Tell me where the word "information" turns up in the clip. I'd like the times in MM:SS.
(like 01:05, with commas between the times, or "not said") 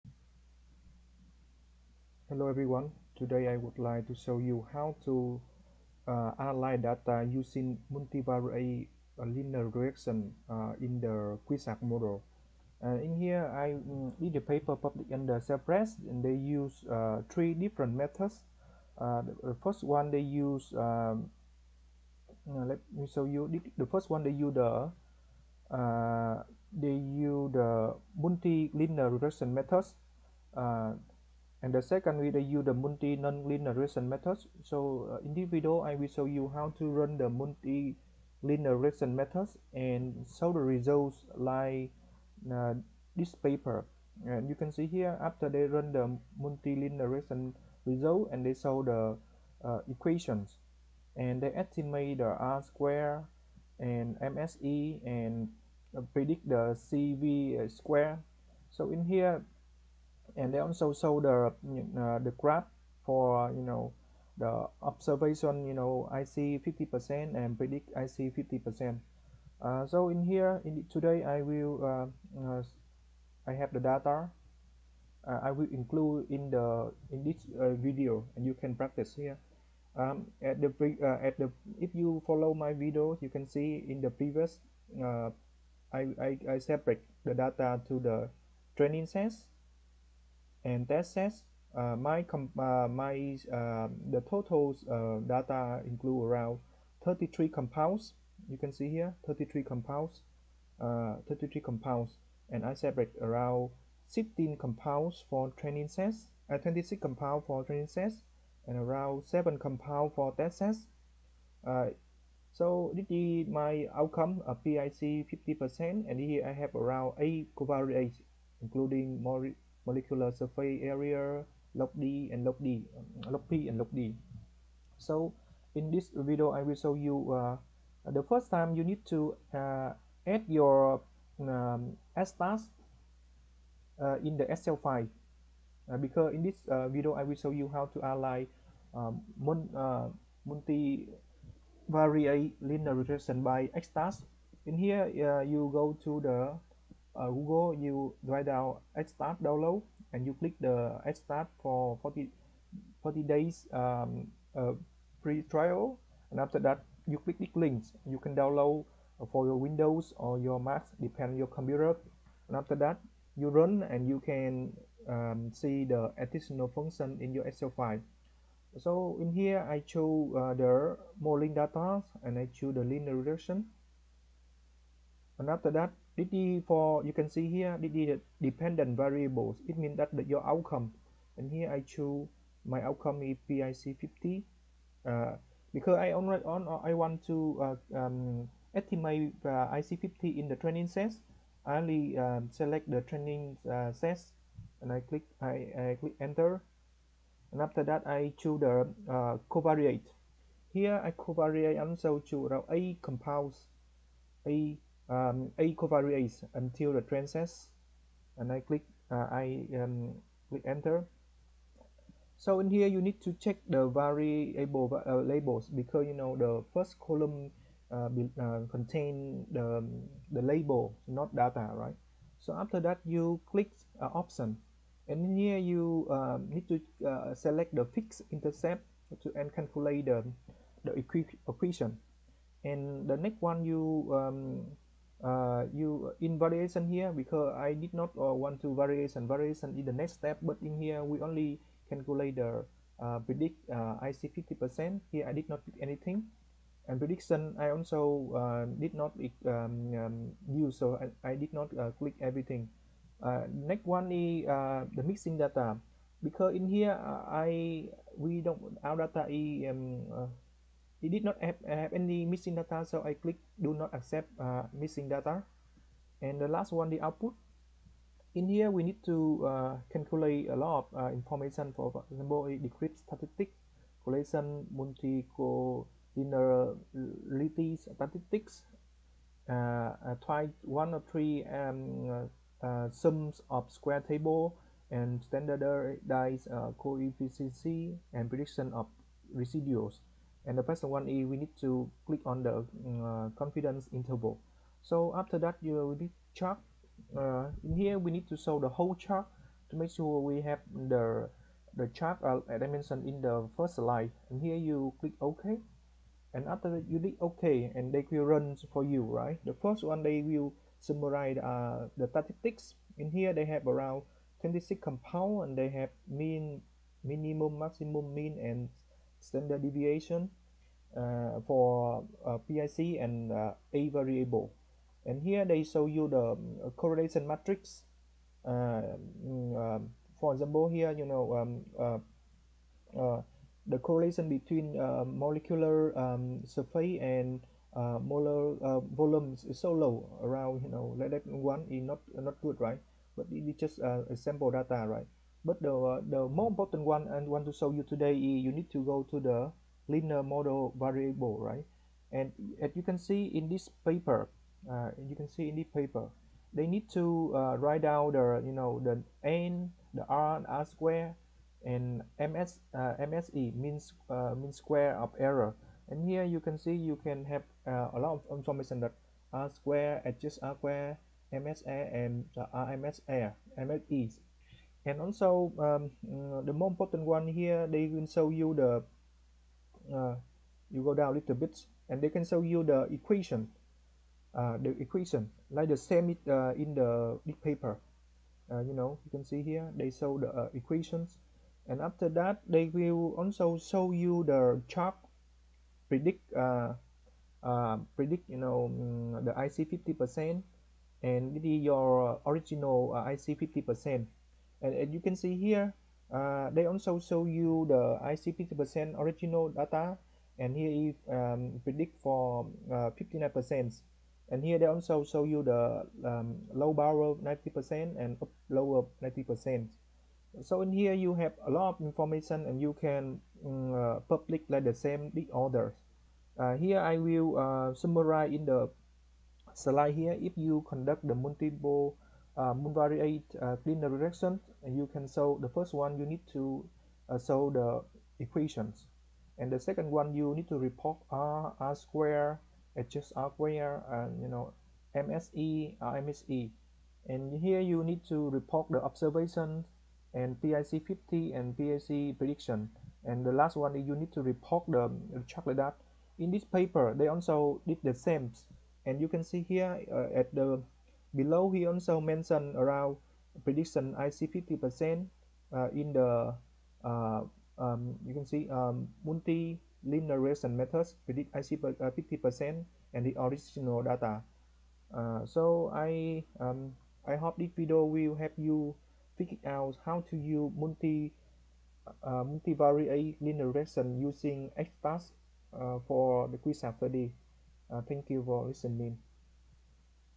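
04:31, 06:08, 07:01.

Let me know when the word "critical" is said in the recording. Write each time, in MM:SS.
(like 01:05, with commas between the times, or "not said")
not said.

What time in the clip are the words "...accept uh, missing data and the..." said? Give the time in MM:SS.
04:23.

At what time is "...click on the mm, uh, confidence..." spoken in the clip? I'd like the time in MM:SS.
04:52.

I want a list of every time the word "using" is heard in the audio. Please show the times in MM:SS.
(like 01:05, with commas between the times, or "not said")
00:07, 08:03.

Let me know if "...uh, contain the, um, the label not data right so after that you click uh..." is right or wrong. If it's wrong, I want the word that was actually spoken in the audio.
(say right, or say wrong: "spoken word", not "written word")
right.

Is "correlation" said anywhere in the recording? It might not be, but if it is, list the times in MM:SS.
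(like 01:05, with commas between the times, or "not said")
04:34, 05:26, 05:33.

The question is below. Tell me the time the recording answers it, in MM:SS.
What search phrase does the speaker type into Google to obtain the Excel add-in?
02:28.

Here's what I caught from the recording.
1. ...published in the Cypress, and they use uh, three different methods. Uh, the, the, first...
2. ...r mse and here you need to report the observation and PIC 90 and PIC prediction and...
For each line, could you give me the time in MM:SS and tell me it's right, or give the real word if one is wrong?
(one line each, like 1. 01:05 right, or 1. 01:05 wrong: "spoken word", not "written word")
1. 00:14 right
2. 07:25 wrong: "50", not "90".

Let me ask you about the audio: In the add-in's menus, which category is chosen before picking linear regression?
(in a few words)
Modeling data.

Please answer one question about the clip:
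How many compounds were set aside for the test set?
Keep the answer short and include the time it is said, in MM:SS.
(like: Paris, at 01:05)
7, at 01:49.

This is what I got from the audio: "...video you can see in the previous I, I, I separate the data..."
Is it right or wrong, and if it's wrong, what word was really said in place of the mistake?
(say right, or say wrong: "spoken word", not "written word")
right.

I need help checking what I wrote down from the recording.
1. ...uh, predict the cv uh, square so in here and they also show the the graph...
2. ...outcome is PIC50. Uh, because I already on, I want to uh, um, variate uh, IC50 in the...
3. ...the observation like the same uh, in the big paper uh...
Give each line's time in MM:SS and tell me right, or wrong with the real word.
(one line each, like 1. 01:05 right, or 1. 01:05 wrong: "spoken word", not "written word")
1. 00:55 right
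2. 03:02 wrong: "estimate", not "variate"
3. 06:24 wrong: "equation", not "observation".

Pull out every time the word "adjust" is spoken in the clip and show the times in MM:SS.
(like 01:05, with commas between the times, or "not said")
06:10, 07:22.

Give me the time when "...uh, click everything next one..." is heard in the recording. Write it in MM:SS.
04:11.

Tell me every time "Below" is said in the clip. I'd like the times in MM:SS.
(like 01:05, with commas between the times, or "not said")
07:41.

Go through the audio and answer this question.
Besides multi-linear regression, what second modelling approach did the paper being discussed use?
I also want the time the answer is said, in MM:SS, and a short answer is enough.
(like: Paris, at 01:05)
Multi nonlinear regression, at 00:32.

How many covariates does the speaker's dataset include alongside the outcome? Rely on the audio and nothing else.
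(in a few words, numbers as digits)
8.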